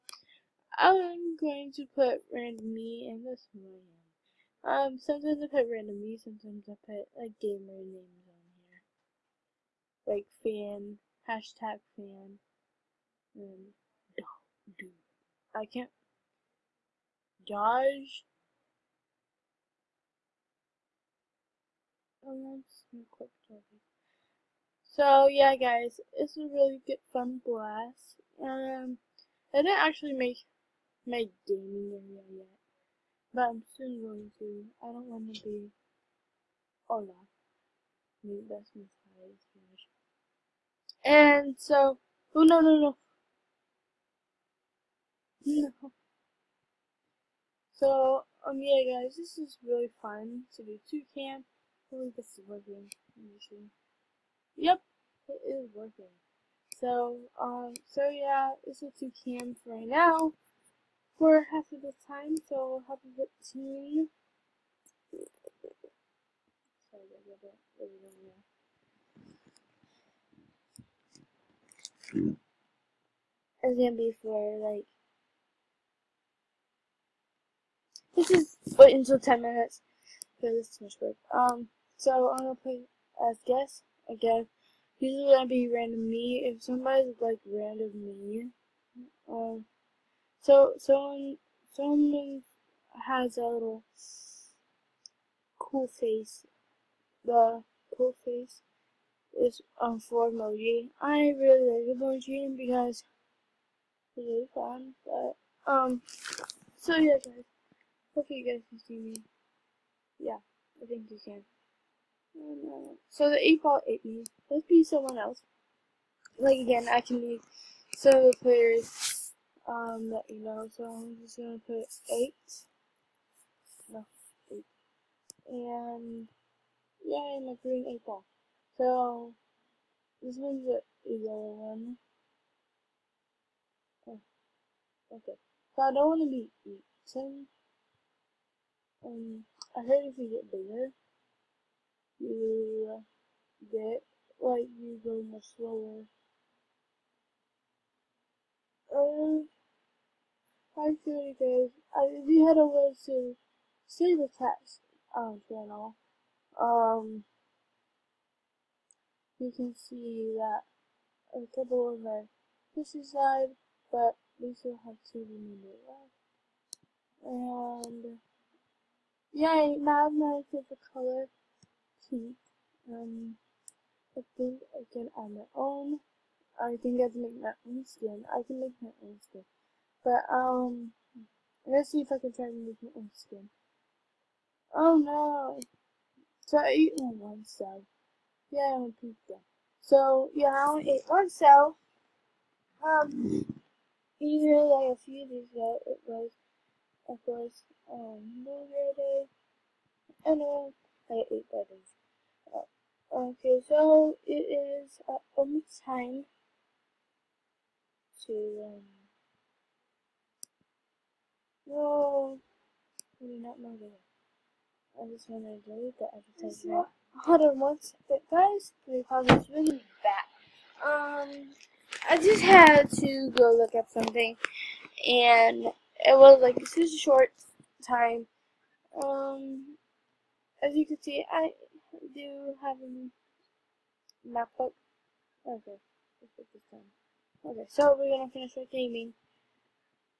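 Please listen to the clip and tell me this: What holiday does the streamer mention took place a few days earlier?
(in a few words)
New Year Day.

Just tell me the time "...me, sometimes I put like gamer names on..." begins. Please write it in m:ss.
0:06.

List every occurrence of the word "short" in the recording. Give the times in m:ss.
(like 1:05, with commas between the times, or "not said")
3:46.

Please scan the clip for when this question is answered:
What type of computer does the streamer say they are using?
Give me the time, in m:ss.
3:54.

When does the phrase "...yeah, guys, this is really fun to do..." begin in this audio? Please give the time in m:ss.
0:48.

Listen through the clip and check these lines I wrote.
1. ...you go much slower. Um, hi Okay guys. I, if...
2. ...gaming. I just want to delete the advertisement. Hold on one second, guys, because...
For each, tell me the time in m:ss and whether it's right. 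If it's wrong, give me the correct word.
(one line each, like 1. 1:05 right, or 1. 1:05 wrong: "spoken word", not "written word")
1. 2:24 wrong: "Cody", not "Okay"
2. 3:33 wrong: "moving", not "gaming".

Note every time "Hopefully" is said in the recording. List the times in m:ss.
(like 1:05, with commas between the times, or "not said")
0:51, 1:48.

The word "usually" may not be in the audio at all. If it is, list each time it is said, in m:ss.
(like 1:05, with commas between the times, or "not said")
1:24, 3:14.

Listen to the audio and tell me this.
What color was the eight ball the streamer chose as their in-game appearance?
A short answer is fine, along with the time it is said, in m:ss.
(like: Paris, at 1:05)
green, at 2:07.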